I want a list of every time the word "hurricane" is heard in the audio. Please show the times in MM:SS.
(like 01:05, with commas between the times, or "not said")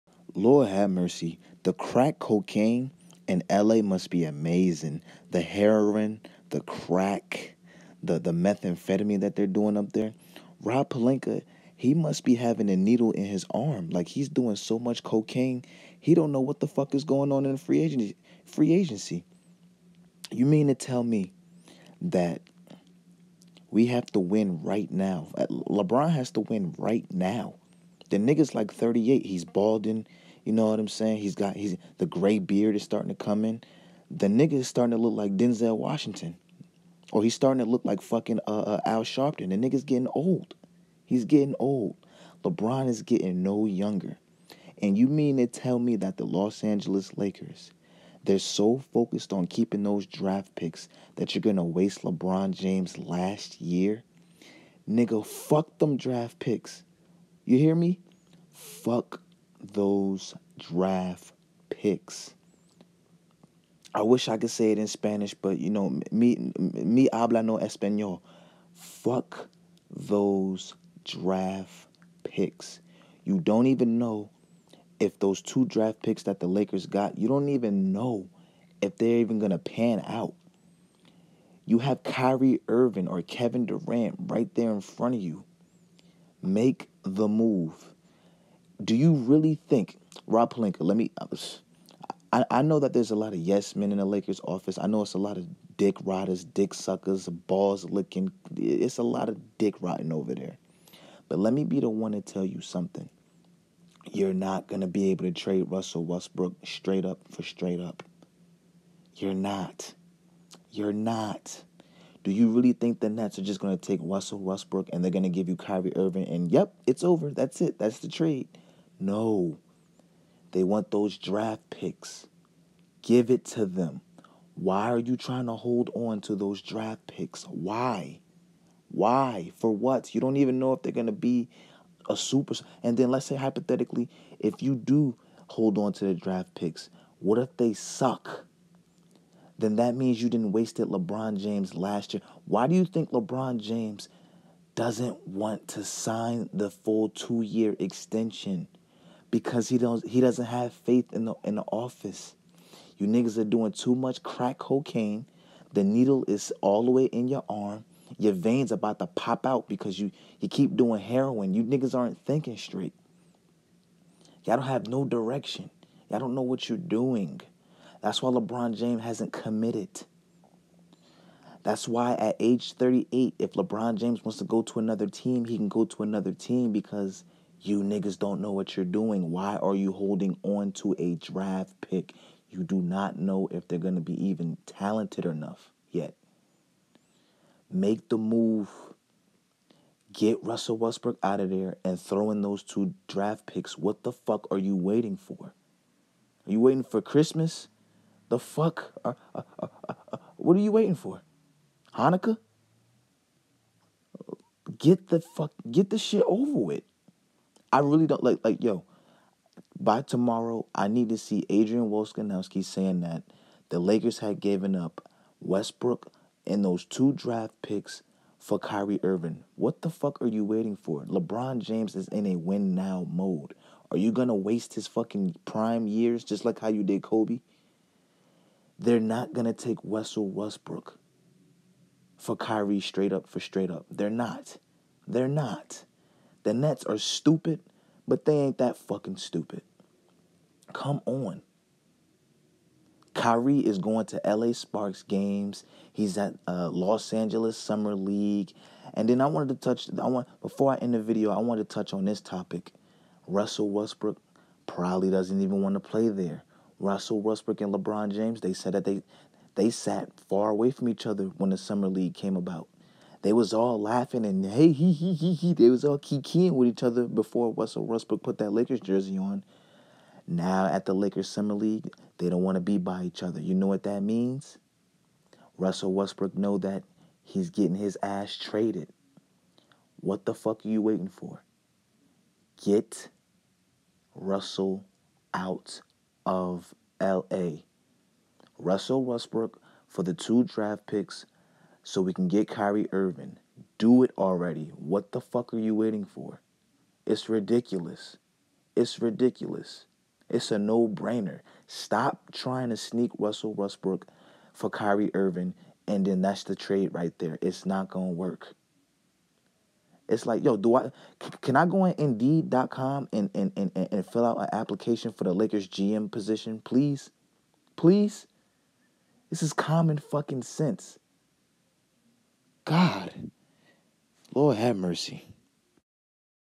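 not said.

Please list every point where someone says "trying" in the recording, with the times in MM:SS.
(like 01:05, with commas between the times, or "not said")
02:05, 05:02.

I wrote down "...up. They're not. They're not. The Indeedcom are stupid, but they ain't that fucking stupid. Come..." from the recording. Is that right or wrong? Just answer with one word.
wrong.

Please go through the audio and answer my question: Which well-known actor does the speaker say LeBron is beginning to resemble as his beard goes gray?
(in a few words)
Denzel Washington.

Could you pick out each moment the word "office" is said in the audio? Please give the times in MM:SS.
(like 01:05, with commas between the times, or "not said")
01:34, 02:31.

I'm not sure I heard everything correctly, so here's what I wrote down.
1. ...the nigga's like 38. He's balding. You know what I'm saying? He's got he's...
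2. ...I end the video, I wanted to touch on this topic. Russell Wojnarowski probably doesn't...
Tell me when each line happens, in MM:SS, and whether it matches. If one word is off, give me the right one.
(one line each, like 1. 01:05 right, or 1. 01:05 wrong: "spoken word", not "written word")
1. 00:28 right
2. 04:10 wrong: "Westbrook", not "Wojnarowski".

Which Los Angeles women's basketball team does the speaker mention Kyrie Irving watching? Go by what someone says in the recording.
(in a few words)
LA Sparks.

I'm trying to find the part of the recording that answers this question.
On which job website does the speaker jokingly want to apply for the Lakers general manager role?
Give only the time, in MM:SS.
05:11.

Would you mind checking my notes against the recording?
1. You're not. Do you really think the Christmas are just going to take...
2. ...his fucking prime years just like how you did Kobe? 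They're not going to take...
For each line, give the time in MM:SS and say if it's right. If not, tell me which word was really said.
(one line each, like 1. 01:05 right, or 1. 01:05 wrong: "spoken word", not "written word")
1. 01:50 wrong: "Nets", not "Christmas"
2. 03:44 right.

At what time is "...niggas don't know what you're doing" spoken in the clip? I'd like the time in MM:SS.
02:57.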